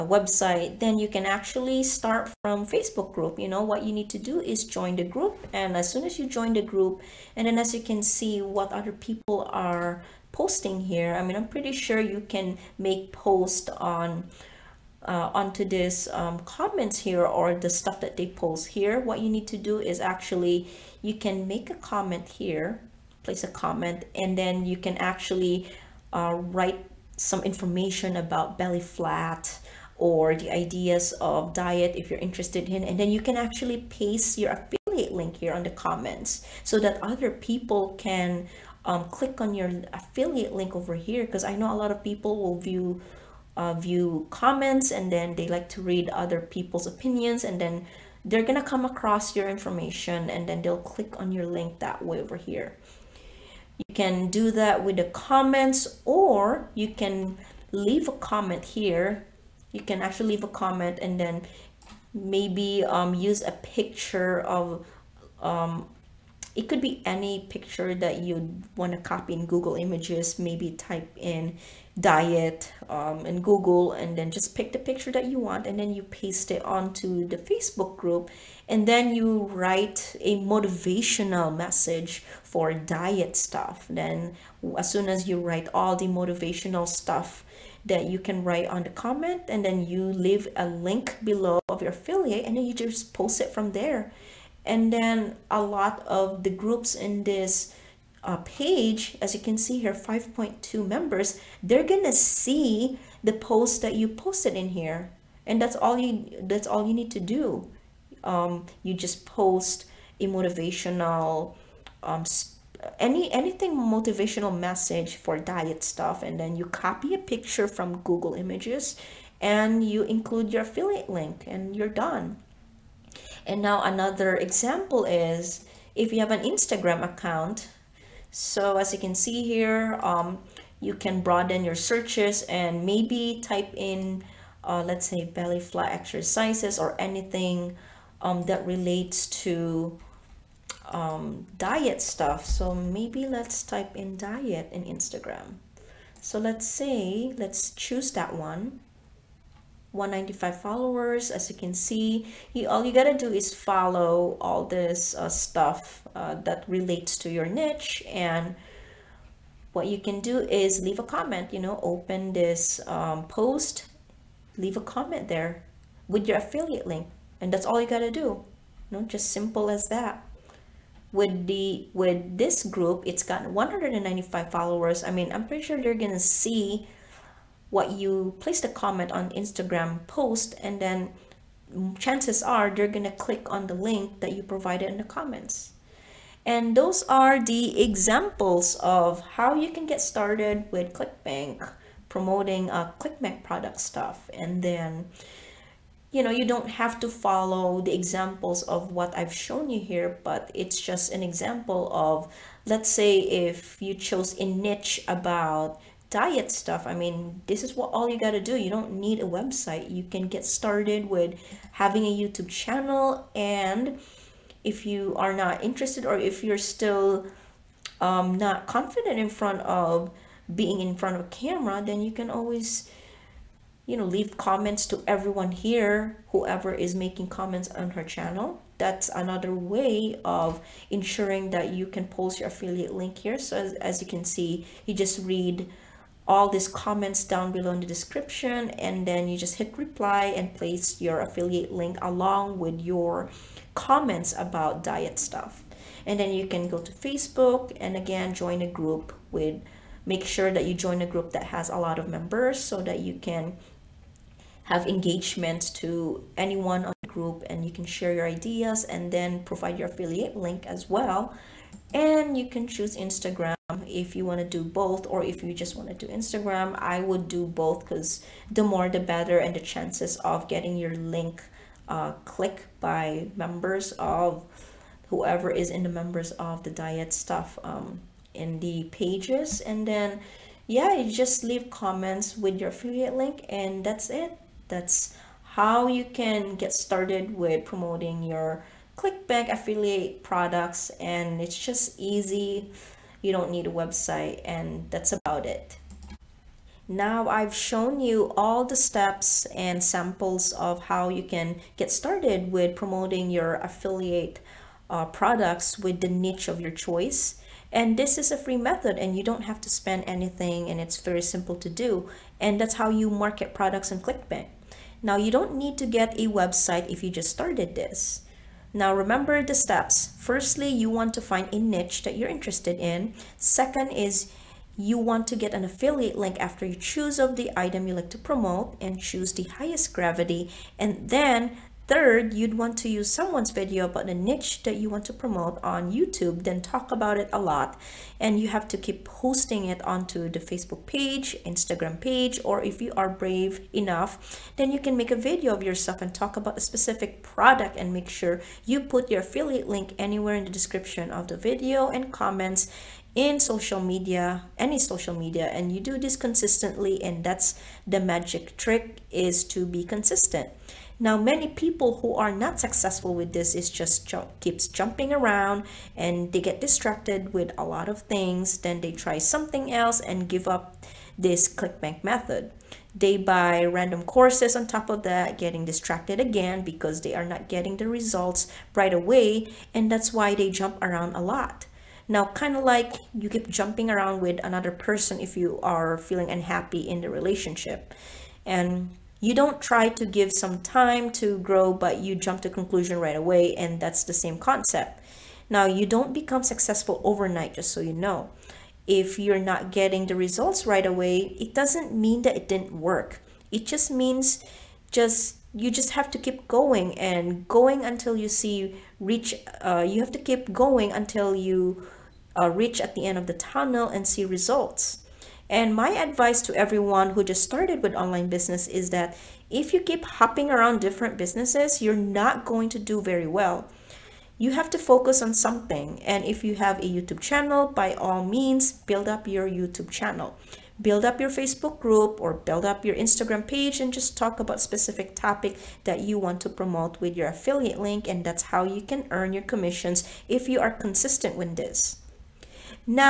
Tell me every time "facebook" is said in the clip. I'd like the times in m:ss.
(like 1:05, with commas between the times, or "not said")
0:02, 1:17, 4:06, 5:40, 7:11.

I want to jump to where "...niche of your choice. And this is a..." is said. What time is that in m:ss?
5:06.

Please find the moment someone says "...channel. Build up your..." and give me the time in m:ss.
7:09.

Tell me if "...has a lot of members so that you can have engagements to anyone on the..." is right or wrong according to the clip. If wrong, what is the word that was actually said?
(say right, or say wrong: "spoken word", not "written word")
right.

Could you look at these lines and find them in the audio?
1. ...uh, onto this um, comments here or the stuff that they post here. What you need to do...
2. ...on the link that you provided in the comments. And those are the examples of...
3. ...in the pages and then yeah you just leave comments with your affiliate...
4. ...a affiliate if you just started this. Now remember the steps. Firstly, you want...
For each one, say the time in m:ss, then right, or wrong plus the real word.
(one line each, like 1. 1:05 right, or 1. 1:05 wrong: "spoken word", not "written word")
1. 0:15 right
2. 3:03 right
3. 4:38 right
4. 5:16 wrong: "website", not "affiliate".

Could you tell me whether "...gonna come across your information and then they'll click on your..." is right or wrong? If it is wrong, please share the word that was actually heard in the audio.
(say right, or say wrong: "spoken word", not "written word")
right.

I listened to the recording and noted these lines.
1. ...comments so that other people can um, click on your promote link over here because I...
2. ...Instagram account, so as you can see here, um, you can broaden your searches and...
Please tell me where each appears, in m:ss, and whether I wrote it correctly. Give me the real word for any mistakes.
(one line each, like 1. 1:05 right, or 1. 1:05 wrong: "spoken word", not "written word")
1. 0:35 wrong: "affiliate", not "promote"
2. 2:06 right.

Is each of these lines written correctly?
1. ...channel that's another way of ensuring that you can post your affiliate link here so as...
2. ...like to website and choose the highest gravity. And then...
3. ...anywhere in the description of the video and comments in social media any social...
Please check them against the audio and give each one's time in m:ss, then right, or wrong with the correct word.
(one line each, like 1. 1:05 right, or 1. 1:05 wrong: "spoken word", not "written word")
1. 3:48 right
2. 5:27 wrong: "promote", not "website"
3. 5:49 right.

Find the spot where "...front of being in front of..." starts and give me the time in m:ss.
3:39.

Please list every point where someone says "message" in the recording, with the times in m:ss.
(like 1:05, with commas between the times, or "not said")
1:21, 1:54.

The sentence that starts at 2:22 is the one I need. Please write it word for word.
So maybe let's type in diet in Instagram.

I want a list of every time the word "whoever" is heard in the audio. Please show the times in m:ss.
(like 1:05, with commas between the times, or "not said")
3:46, 4:35.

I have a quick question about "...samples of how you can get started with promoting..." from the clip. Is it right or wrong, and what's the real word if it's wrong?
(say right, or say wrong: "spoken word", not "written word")
right.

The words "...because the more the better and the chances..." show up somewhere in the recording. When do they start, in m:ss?
4:27.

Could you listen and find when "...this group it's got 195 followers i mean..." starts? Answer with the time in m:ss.
2:52.